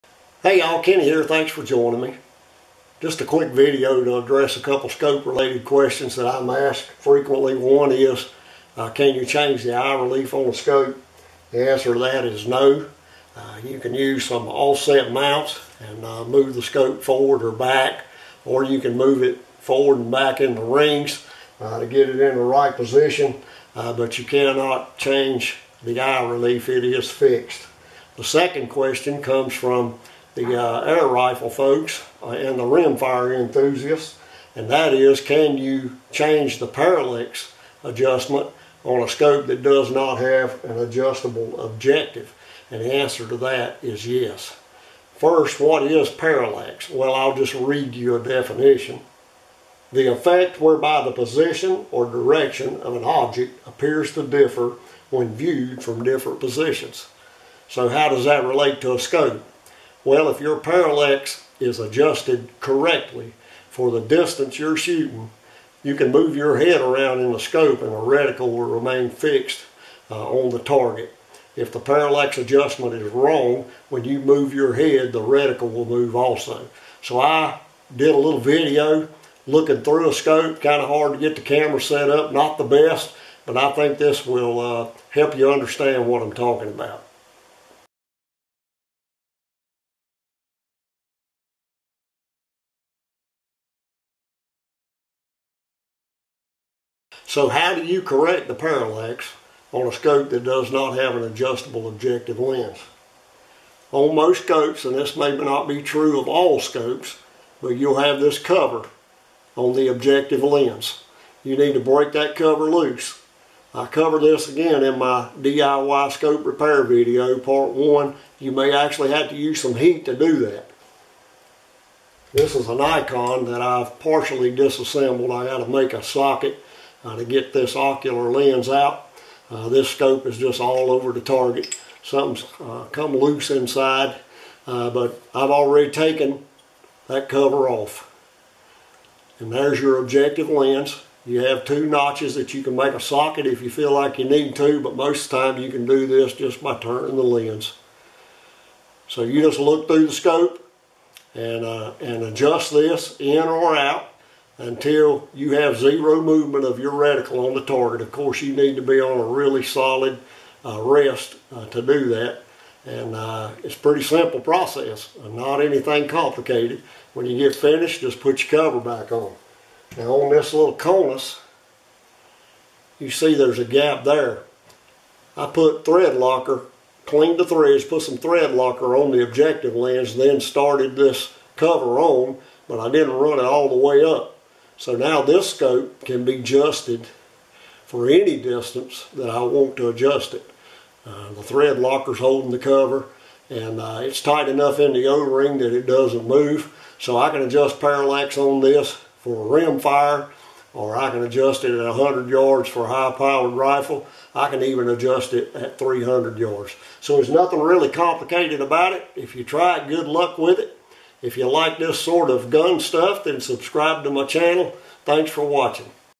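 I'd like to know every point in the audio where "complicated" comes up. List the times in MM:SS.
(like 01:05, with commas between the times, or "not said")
02:46, 03:27.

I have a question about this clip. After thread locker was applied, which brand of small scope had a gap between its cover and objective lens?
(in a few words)
Konus.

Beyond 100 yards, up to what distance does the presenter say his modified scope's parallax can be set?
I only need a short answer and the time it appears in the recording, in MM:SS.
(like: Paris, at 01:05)
300 yards, at 03:25.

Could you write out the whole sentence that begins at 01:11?
If the parallax adjustment is wrong, when you move your head, the reticle will move also.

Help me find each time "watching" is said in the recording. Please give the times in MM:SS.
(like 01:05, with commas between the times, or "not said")
03:35.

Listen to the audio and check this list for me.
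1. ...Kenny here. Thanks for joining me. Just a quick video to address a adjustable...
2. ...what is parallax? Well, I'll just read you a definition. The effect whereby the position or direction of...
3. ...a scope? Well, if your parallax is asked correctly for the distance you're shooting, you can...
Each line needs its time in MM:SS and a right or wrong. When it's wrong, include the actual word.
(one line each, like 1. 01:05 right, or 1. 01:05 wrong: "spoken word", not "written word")
1. 00:00 wrong: "couple", not "adjustable"
2. 00:45 right
3. 00:58 wrong: "adjusted", not "asked".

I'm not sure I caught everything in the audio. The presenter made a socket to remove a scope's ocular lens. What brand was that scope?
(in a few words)
Nikon.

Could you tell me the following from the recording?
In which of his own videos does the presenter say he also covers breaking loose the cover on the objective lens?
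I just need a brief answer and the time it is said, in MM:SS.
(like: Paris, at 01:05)
DIY scope repair video, part one, at 01:55.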